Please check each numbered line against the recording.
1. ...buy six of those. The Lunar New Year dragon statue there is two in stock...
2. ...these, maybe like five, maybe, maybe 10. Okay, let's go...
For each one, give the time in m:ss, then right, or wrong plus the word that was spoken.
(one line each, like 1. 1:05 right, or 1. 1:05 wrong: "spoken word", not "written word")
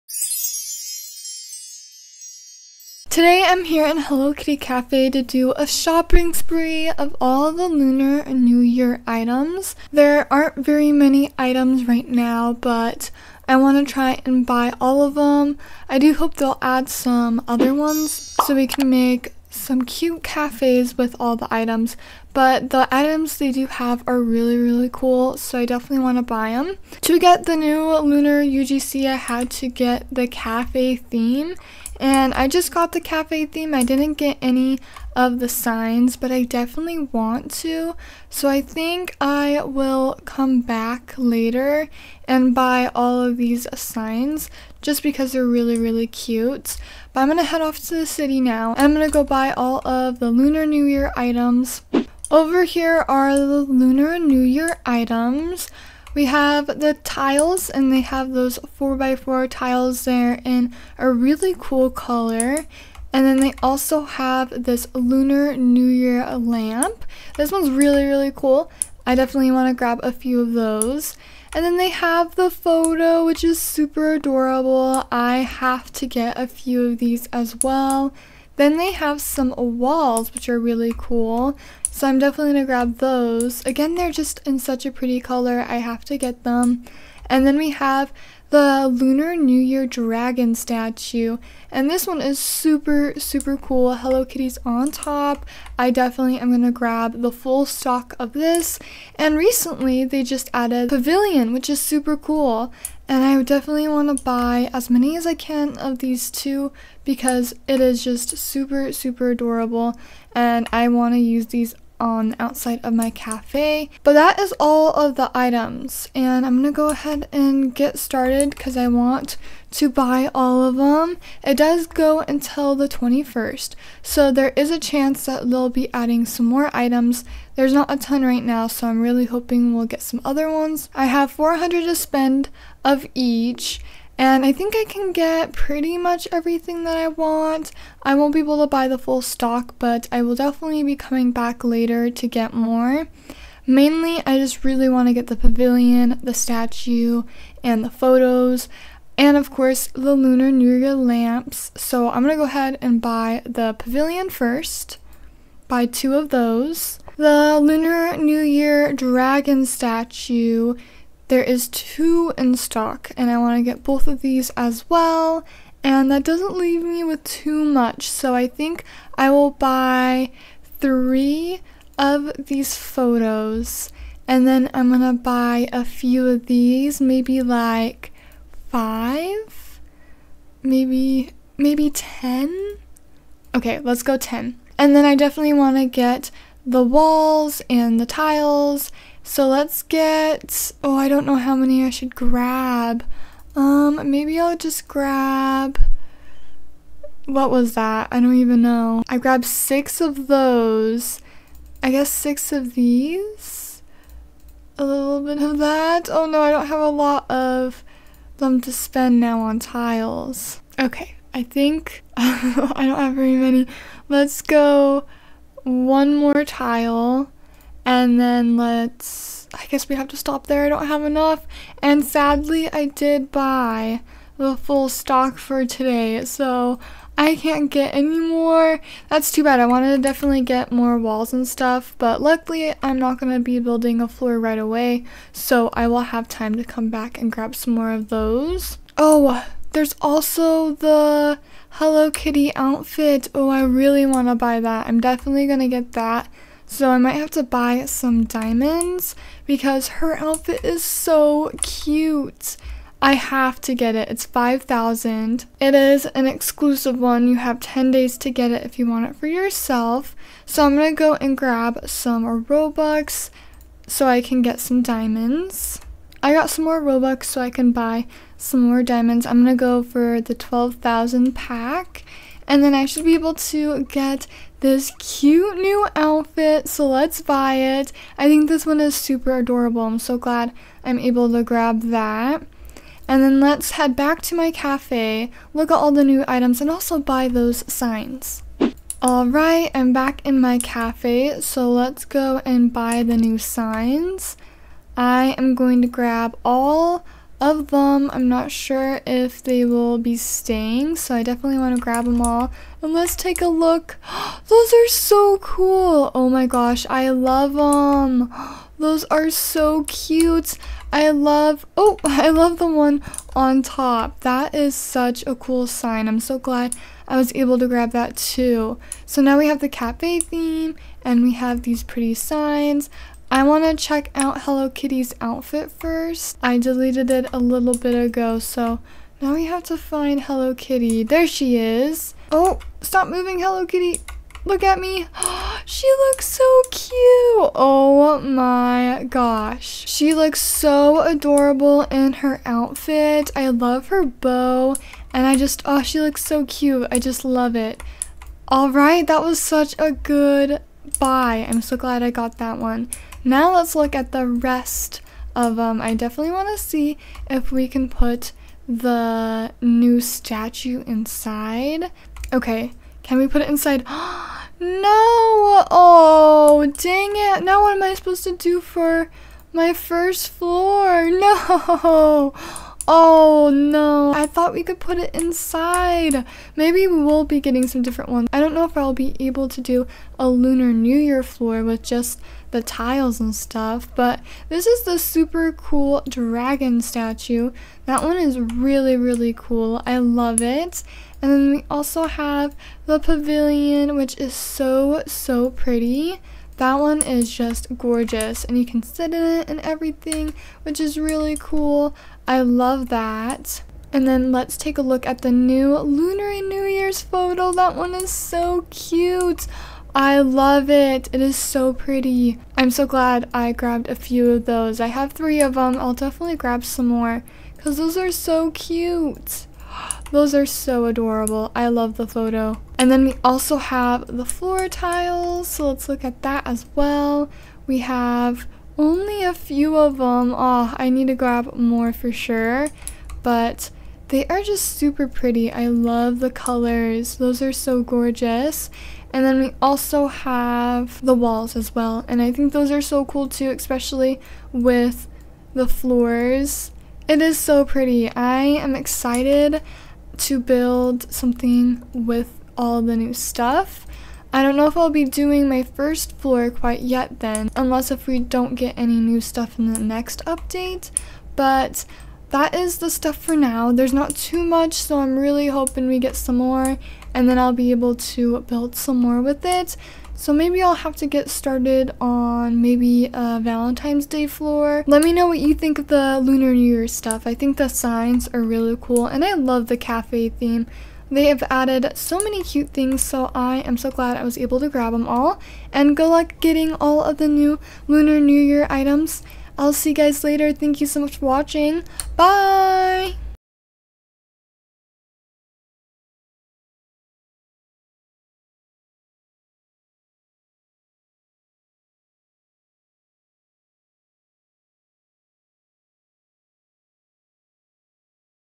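1. 2:35 wrong: "two", not "six"
2. 2:56 right.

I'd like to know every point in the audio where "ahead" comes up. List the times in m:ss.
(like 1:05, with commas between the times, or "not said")
1:56, 2:32.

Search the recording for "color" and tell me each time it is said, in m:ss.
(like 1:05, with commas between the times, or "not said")
1:01, 1:25, 7:16.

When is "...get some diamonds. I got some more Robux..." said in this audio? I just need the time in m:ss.
4:24.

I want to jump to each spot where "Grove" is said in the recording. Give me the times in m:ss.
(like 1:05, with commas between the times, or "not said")
not said.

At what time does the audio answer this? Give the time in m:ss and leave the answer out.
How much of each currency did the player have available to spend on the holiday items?
2:11.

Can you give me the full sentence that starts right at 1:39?
And recently, they just added Pavilion, which is super cool.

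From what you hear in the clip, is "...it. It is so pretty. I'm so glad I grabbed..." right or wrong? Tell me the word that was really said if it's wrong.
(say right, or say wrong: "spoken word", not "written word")
right.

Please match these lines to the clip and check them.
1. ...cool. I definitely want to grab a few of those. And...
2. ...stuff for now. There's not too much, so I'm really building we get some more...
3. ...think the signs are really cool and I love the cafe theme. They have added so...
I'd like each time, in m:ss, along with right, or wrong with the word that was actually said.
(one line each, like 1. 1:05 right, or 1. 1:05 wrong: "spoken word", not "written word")
1. 1:08 right
2. 7:42 wrong: "hoping", not "building"
3. 7:57 right.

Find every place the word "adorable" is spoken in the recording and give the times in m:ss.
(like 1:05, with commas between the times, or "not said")
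1:14, 1:49, 4:39, 5:40, 7:00.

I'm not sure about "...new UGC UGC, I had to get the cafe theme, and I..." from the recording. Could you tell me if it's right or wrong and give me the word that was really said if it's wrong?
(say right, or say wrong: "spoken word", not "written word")
wrong: "Lunar", not "UGC".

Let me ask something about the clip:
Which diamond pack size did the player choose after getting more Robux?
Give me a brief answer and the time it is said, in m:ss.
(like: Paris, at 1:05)
12,000, at 4:30.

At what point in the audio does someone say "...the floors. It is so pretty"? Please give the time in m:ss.
7:25.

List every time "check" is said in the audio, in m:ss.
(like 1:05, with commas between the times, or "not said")
5:23.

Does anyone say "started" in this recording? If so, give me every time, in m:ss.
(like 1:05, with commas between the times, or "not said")
1:57, 7:51.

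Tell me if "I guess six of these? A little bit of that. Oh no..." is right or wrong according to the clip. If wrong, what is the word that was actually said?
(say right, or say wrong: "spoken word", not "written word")
right.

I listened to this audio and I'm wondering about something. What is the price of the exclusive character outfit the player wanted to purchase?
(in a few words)
5,000.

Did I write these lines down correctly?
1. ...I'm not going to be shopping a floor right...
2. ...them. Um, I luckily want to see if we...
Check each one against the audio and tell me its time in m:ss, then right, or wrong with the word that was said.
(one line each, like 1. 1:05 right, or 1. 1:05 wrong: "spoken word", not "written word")
1. 3:52 wrong: "building", not "shopping"
2. 5:55 wrong: "definitely", not "luckily".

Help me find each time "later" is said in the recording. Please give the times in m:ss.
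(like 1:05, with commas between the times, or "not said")
0:41, 2:21, 8:10.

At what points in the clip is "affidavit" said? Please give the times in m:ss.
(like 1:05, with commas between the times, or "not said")
not said.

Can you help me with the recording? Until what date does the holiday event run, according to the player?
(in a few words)
The 21st.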